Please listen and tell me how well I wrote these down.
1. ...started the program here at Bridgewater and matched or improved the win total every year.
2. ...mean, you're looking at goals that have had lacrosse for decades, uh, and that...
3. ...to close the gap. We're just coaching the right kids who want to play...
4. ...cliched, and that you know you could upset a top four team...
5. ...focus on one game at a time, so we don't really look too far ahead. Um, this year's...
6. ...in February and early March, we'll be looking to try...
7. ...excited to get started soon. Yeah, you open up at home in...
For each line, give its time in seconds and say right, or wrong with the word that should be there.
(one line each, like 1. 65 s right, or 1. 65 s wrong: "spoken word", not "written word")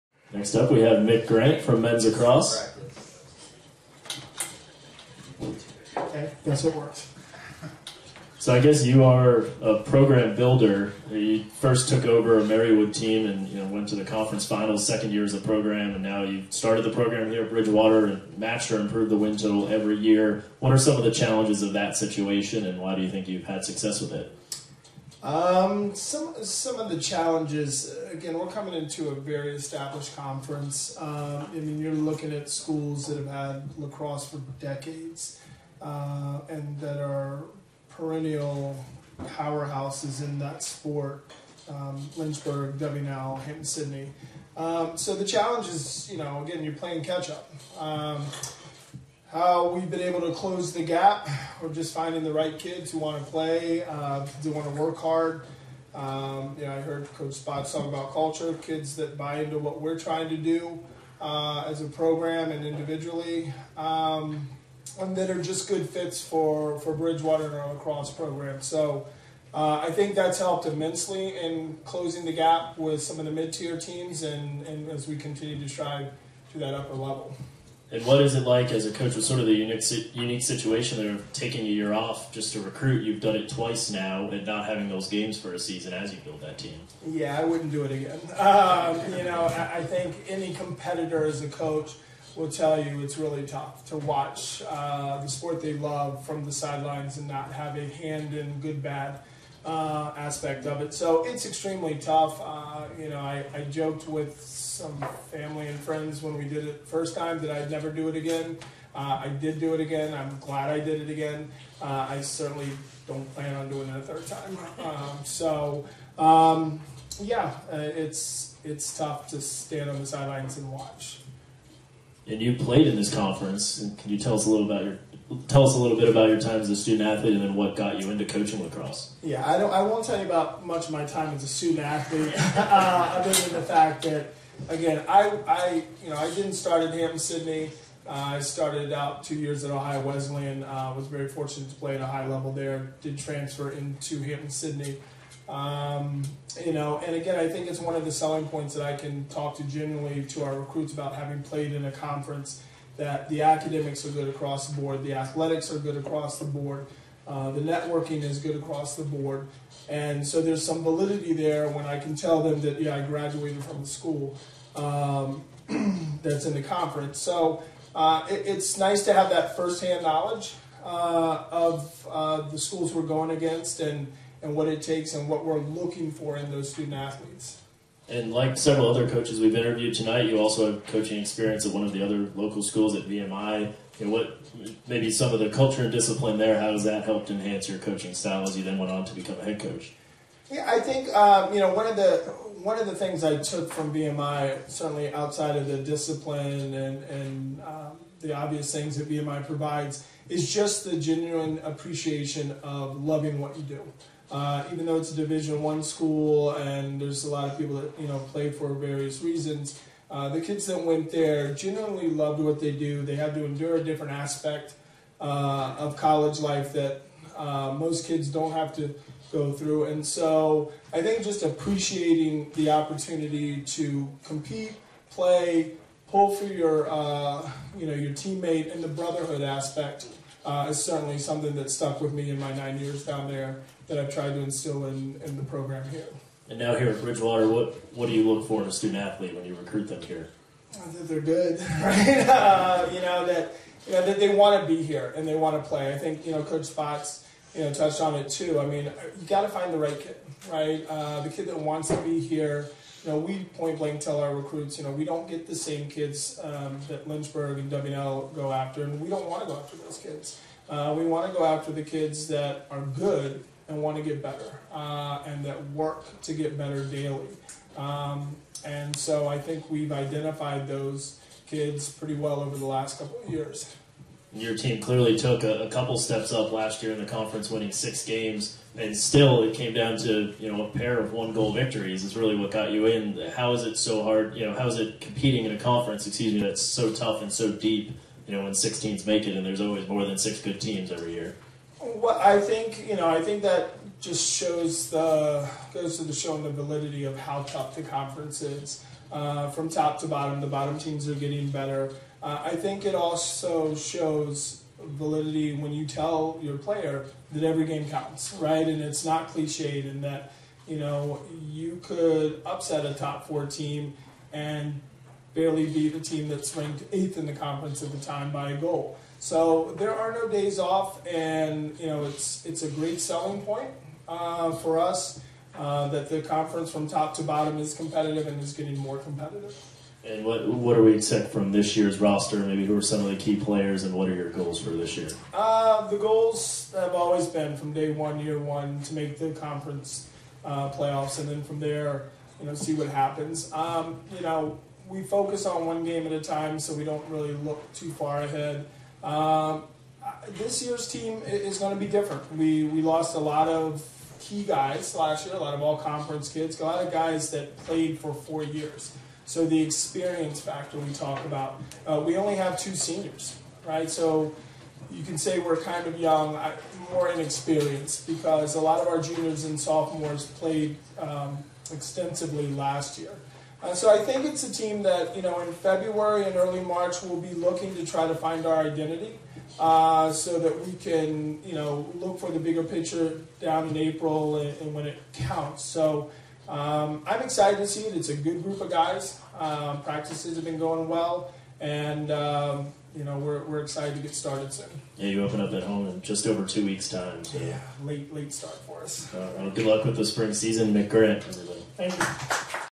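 1. 16 s right
2. 31 s wrong: "schools", not "goals"
3. 50 s wrong: "finding", not "coaching"
4. 309 s right
5. 345 s right
6. 375 s right
7. 393 s right.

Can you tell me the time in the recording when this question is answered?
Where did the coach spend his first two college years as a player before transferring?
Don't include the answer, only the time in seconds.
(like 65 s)
139 s.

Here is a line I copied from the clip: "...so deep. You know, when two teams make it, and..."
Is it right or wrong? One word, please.
wrong.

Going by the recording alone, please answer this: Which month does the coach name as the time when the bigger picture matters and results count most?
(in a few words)
April.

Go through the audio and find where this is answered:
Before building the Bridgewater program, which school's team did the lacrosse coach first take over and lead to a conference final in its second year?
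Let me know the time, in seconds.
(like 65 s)
12 s.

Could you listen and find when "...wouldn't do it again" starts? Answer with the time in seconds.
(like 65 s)
87 s.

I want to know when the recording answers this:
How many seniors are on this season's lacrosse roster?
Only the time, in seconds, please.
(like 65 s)
362 s.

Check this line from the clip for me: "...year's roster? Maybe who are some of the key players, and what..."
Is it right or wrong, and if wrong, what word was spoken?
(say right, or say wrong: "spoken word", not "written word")
right.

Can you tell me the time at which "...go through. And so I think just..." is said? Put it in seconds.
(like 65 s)
219 s.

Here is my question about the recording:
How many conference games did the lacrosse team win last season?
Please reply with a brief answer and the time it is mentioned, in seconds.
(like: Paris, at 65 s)
6, at 277 s.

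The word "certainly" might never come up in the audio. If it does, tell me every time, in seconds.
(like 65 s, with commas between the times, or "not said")
112 s, 194 s, 230 s.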